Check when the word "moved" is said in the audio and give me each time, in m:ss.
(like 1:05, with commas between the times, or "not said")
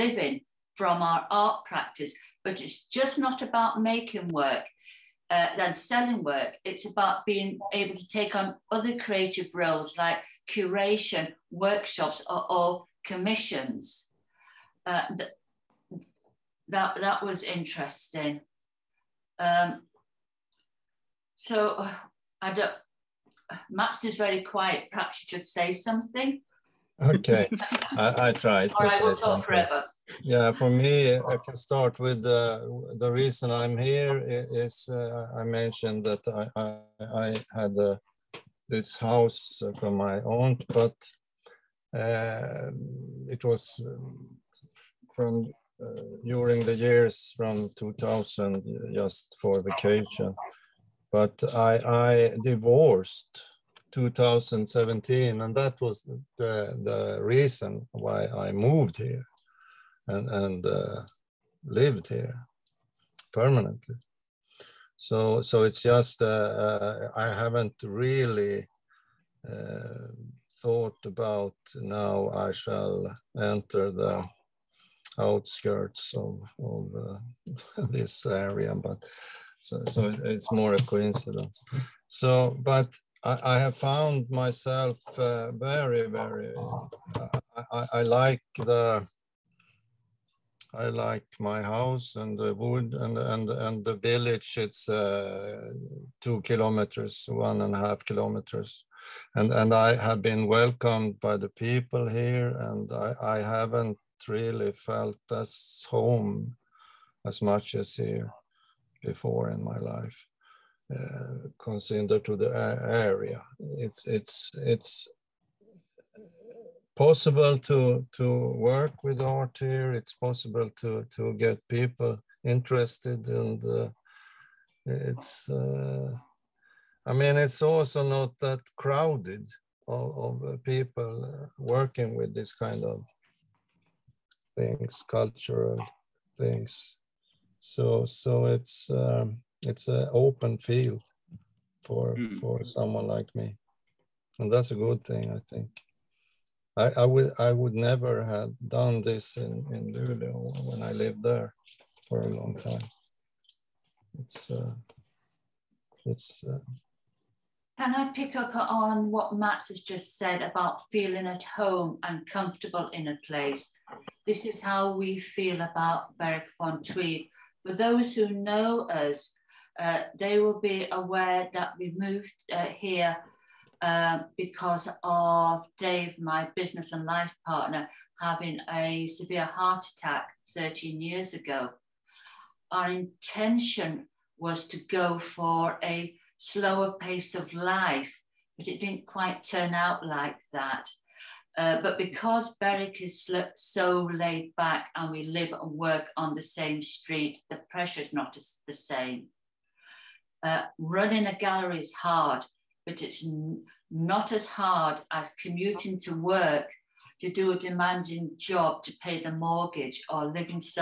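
0:58, 2:51.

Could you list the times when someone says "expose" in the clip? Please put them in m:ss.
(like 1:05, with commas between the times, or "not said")
not said.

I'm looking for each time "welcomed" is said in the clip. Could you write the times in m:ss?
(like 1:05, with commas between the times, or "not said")
1:40.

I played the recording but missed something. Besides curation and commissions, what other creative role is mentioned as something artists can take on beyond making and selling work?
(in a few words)
workshops.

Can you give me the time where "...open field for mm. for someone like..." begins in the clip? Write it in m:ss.
2:20.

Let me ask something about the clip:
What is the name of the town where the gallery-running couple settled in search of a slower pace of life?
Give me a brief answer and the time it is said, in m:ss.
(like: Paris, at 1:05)
Berwick upon Tweed, at 2:46.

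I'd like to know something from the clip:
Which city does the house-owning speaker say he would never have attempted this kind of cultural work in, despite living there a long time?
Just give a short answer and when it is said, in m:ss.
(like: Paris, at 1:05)
Luleå, at 2:29.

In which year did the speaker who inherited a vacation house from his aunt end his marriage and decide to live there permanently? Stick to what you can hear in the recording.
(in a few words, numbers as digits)
2017.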